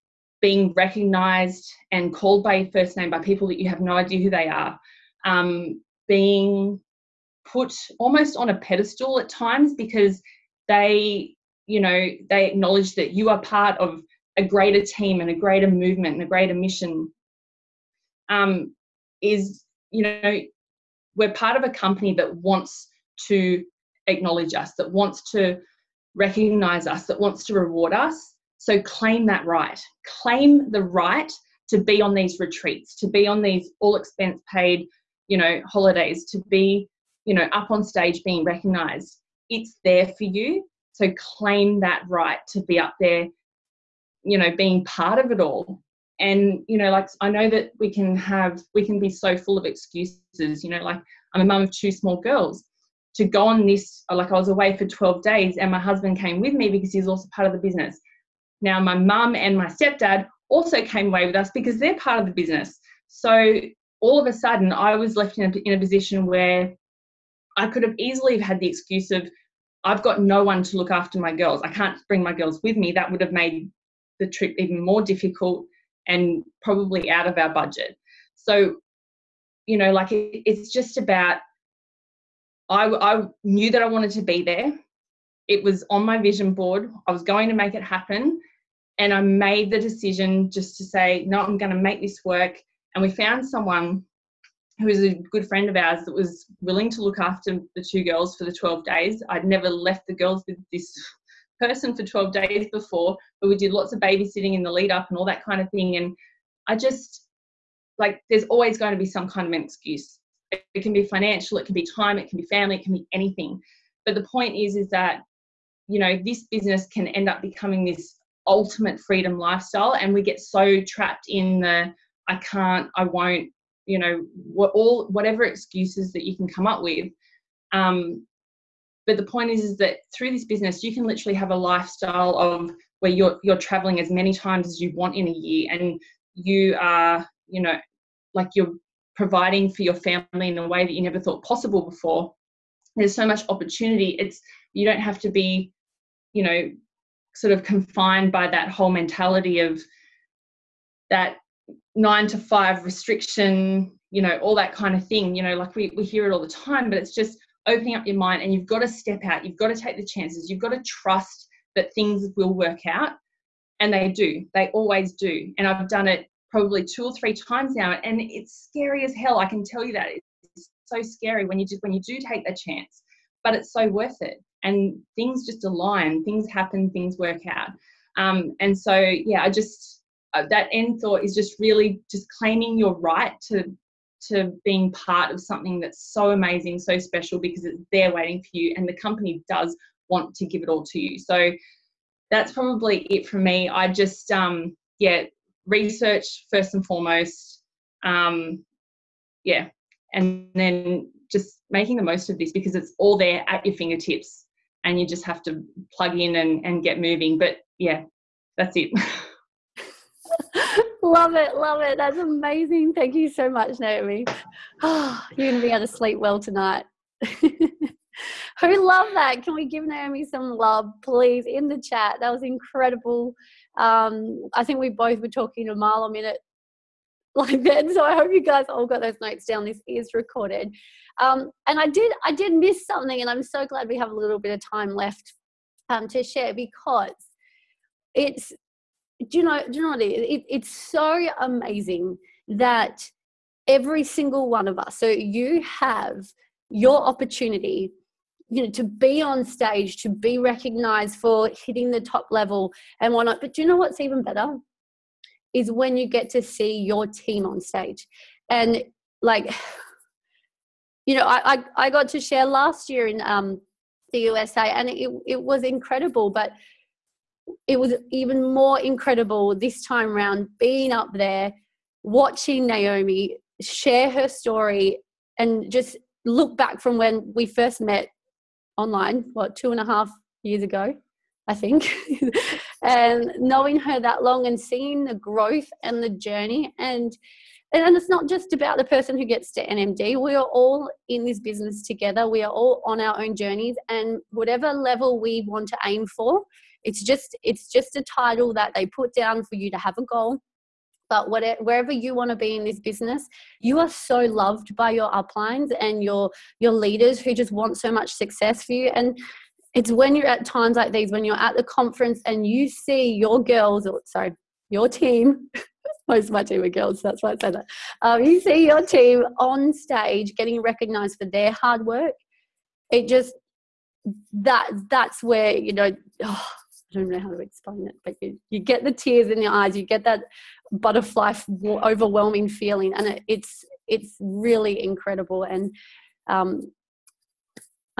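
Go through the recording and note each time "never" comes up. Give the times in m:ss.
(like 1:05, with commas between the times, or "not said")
1:39, 2:20.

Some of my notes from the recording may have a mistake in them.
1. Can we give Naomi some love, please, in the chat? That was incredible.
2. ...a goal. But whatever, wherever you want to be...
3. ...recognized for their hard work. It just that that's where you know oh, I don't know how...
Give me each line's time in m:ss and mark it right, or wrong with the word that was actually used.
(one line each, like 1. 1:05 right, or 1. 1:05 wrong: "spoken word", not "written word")
1. 3:39 right
2. 4:59 right
3. 5:20 right.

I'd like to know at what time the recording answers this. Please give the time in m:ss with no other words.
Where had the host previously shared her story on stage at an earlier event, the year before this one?
4:24.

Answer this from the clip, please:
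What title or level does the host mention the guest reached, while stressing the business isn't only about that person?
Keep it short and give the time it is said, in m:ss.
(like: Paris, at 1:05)
NMD, at 4:49.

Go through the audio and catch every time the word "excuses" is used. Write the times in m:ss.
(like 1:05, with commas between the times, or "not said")
0:49, 1:08, 1:49, 2:05.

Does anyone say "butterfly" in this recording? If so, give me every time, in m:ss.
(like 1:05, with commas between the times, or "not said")
5:30.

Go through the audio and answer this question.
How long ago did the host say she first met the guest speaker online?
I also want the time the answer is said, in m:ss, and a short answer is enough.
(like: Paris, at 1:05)
two and a half years, at 4:39.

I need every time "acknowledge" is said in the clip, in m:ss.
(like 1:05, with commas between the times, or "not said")
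0:12, 0:24.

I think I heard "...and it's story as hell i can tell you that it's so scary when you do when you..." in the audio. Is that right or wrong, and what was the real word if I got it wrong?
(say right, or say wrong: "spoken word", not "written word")
wrong: "scary", not "story".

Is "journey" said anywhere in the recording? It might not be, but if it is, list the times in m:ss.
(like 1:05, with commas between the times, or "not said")
4:46, 4:53.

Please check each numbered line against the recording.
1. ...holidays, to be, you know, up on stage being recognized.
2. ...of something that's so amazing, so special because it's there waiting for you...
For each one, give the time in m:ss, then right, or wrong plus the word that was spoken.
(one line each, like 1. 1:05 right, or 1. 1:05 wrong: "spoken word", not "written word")
1. 0:35 right
2. 3:05 right.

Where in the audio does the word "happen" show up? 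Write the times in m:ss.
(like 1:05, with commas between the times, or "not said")
1:27, 2:56.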